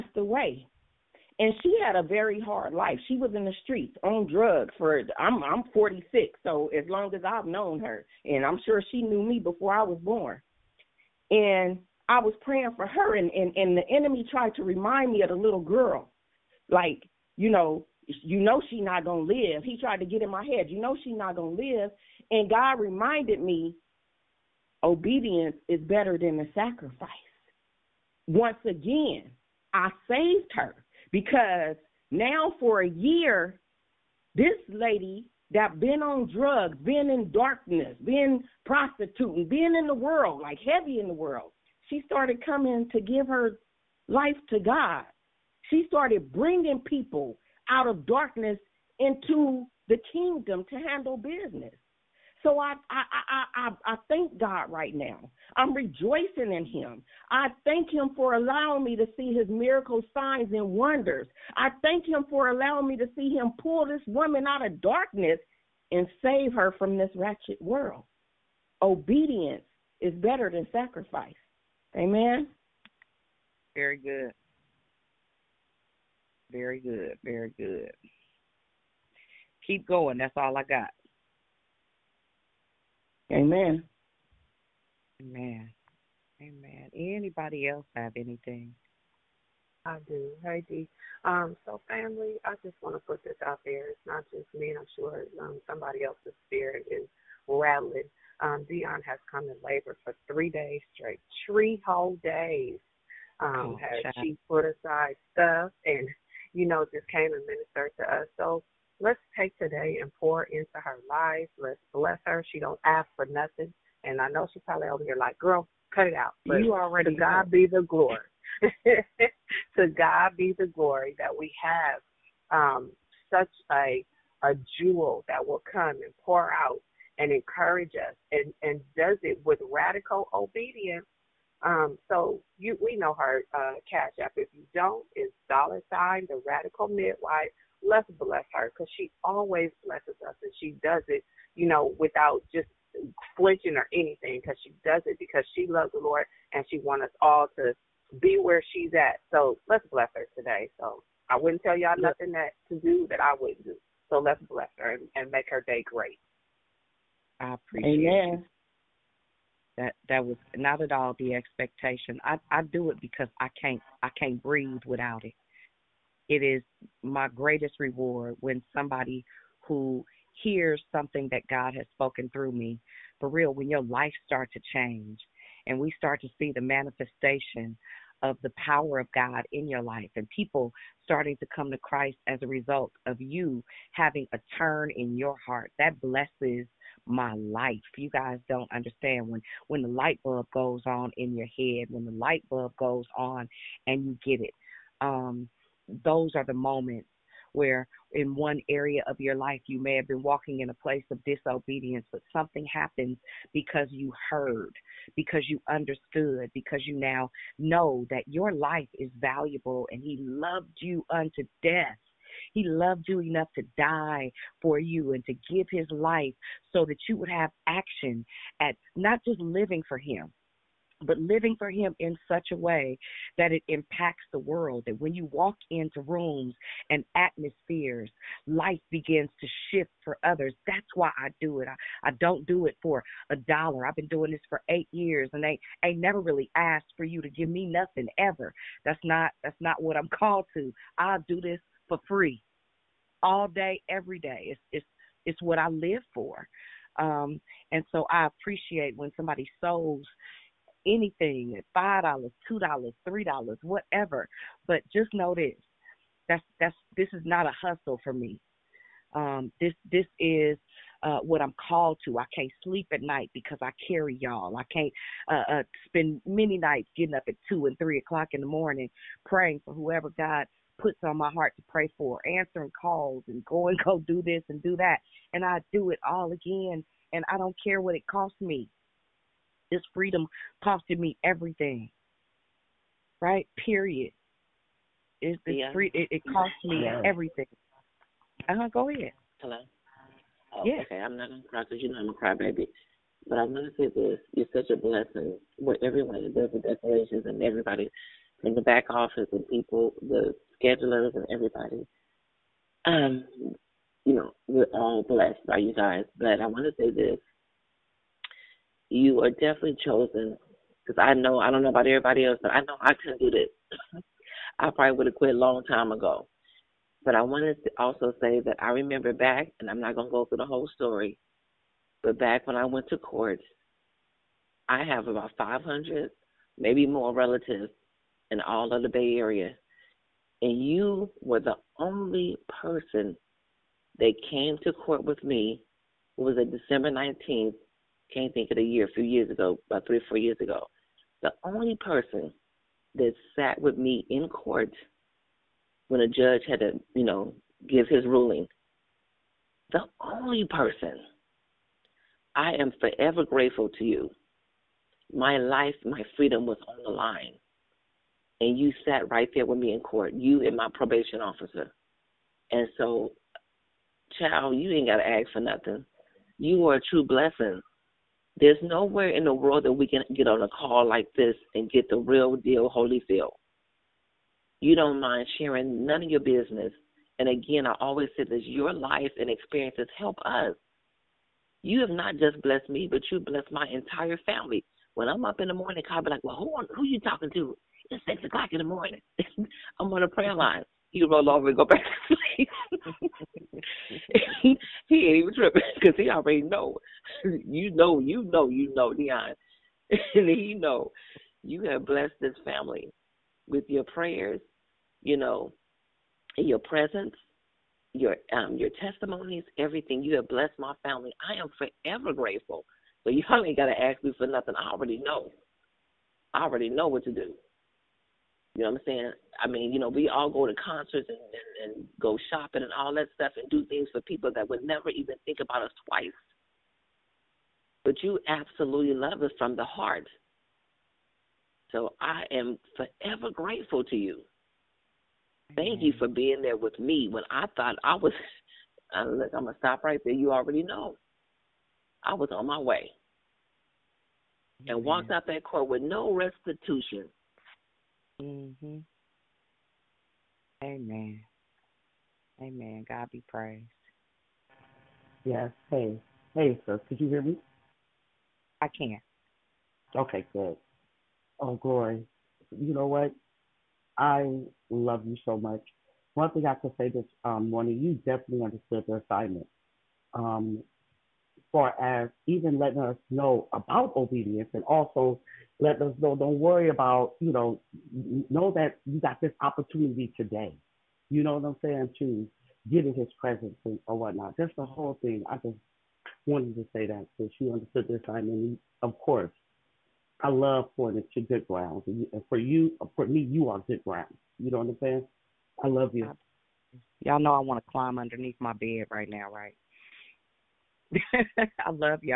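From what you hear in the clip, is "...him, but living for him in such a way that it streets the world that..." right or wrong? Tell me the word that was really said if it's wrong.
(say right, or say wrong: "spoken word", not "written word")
wrong: "impacts", not "streets".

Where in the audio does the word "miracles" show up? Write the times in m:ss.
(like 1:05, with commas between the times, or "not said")
0:59.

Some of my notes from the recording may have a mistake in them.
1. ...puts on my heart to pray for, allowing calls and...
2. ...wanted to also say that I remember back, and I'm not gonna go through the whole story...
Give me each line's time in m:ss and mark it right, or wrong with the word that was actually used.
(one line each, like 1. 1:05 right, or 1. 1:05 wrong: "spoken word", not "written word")
1. 4:30 wrong: "answering", not "allowing"
2. 5:17 right.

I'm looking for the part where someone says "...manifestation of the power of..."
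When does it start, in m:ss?
2:56.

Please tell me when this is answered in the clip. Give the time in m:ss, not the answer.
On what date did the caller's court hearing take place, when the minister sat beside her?
5:36.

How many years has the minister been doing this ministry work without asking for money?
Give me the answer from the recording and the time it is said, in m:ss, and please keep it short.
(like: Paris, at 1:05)
8, at 3:54.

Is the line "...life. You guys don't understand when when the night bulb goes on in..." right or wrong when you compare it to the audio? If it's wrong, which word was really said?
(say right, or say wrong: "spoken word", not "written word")
wrong: "light", not "night".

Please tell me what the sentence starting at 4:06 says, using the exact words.
Um, and so I appreciate when somebody sows anything at five dollars, two dollars, three dollars, whatever.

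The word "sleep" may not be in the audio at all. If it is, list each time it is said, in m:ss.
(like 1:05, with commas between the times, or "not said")
4:22, 6:32.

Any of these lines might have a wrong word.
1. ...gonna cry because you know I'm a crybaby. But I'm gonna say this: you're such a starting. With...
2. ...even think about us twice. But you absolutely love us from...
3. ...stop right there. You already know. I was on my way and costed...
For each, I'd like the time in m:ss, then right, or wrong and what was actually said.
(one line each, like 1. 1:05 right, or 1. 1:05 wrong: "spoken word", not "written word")
1. 4:51 wrong: "blessing", not "starting"
2. 7:04 right
3. 7:19 wrong: "walked", not "costed".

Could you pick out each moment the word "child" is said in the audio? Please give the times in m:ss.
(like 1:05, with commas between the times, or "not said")
6:04.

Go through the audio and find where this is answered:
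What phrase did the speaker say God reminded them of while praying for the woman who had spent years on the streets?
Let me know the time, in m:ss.
0:24.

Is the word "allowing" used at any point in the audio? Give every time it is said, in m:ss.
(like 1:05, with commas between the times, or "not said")
0:58, 1:02.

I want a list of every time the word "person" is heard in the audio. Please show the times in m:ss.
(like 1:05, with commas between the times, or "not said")
5:32, 5:41, 5:50.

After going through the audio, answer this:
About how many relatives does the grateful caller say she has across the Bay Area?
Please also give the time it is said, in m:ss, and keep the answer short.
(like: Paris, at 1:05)
500, at 5:25.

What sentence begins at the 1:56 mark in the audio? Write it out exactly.
But you already to God be the glory.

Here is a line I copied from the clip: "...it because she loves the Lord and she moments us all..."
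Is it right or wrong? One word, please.
wrong.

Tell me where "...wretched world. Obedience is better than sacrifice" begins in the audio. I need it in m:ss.
1:07.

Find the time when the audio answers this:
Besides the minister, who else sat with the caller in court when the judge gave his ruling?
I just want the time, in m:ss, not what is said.
6:00.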